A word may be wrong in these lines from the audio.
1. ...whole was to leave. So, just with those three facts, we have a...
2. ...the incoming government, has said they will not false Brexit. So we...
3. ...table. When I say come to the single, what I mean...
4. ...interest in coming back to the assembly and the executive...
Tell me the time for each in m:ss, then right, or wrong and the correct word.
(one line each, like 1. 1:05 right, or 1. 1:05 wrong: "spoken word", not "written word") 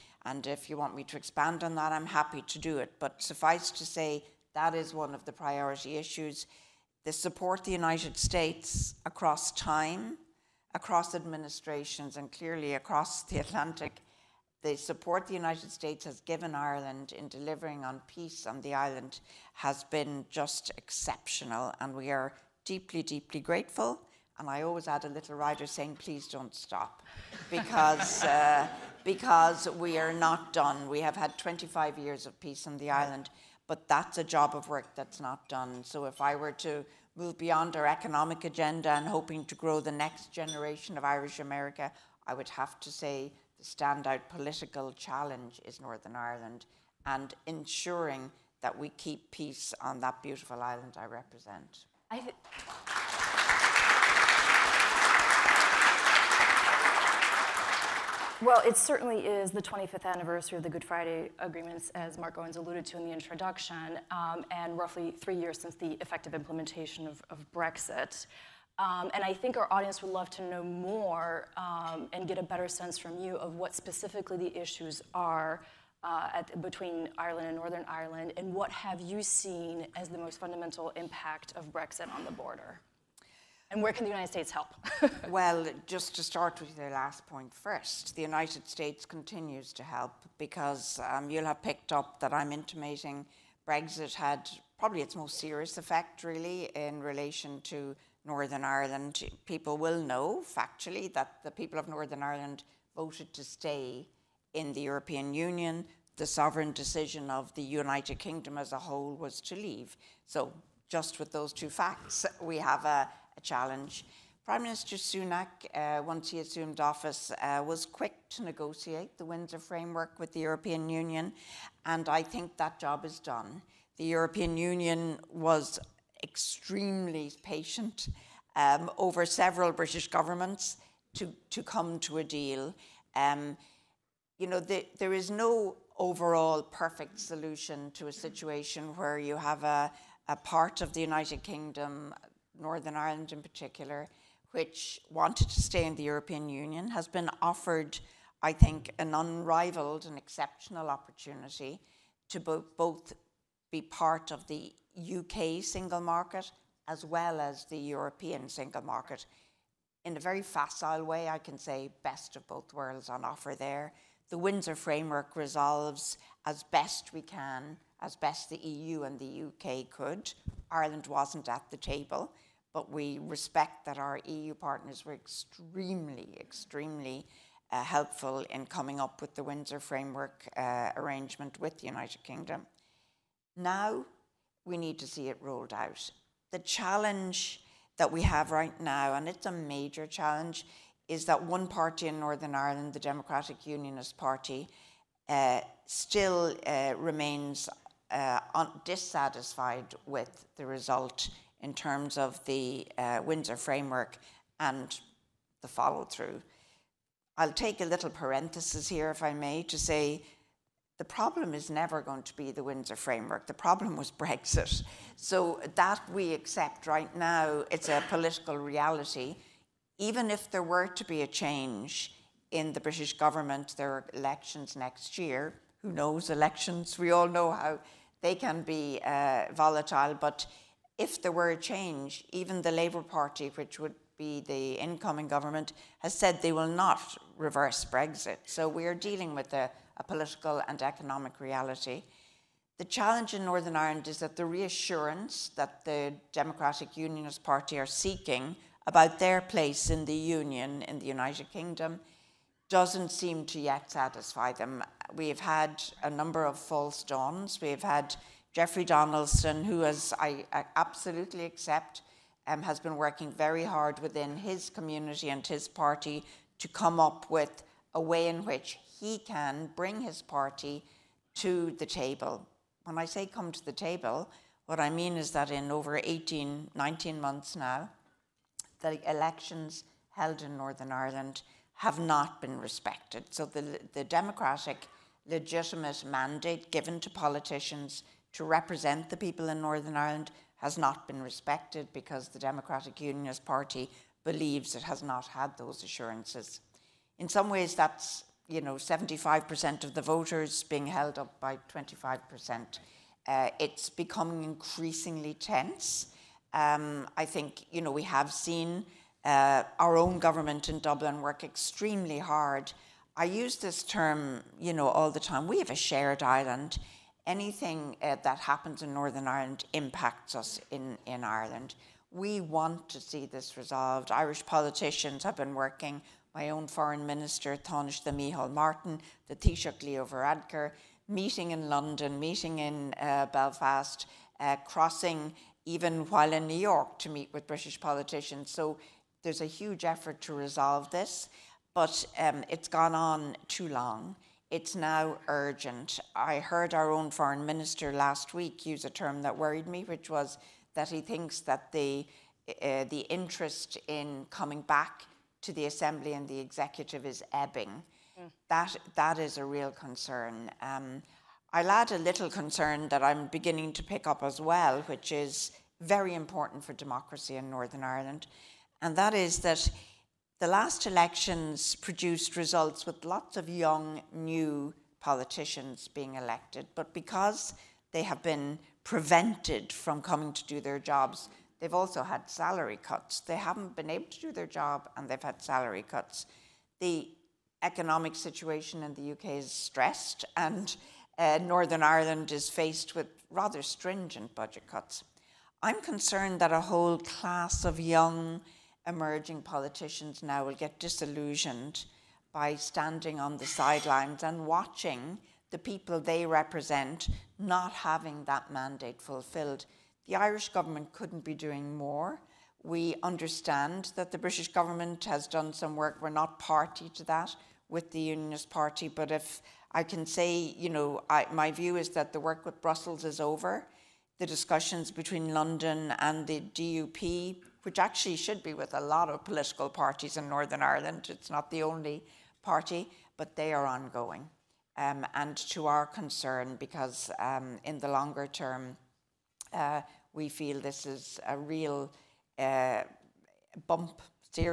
1. 1:48 wrong: "two", not "three"
2. 3:54 wrong: "reverse", not "false"
3. 4:31 wrong: "table", not "single"
4. 5:53 right.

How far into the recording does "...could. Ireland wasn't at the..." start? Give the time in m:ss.
2:49.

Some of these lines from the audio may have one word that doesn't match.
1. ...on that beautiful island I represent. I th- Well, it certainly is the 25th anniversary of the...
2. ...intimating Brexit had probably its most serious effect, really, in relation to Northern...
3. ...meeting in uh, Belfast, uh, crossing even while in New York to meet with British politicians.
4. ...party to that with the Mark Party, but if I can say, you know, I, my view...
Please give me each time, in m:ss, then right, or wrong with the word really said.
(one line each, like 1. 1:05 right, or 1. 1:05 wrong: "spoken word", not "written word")
1. 0:49 right
2. 1:32 right
3. 5:32 right
4. 6:56 wrong: "Unionist", not "Mark".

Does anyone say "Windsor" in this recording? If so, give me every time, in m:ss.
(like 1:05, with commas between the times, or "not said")
1:59, 2:44, 2:59, 3:23, 3:32.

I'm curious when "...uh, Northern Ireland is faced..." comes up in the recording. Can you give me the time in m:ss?
6:31.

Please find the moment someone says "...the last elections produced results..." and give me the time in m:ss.
6:10.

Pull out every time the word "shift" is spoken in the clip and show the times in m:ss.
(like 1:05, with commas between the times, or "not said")
not said.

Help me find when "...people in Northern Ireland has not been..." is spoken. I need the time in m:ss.
4:49.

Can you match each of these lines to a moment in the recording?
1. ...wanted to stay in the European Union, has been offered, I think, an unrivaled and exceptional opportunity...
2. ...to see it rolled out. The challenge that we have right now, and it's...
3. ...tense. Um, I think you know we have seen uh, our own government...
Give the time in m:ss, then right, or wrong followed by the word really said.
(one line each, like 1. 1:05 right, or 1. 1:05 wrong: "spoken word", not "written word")
1. 2:25 right
2. 3:05 right
3. 5:05 right.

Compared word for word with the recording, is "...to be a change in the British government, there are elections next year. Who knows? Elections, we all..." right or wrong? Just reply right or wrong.
right.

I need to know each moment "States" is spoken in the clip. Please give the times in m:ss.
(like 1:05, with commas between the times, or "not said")
0:08, 0:15, 1:24, 1:28.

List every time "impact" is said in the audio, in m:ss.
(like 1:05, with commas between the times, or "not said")
1:20, 5:19.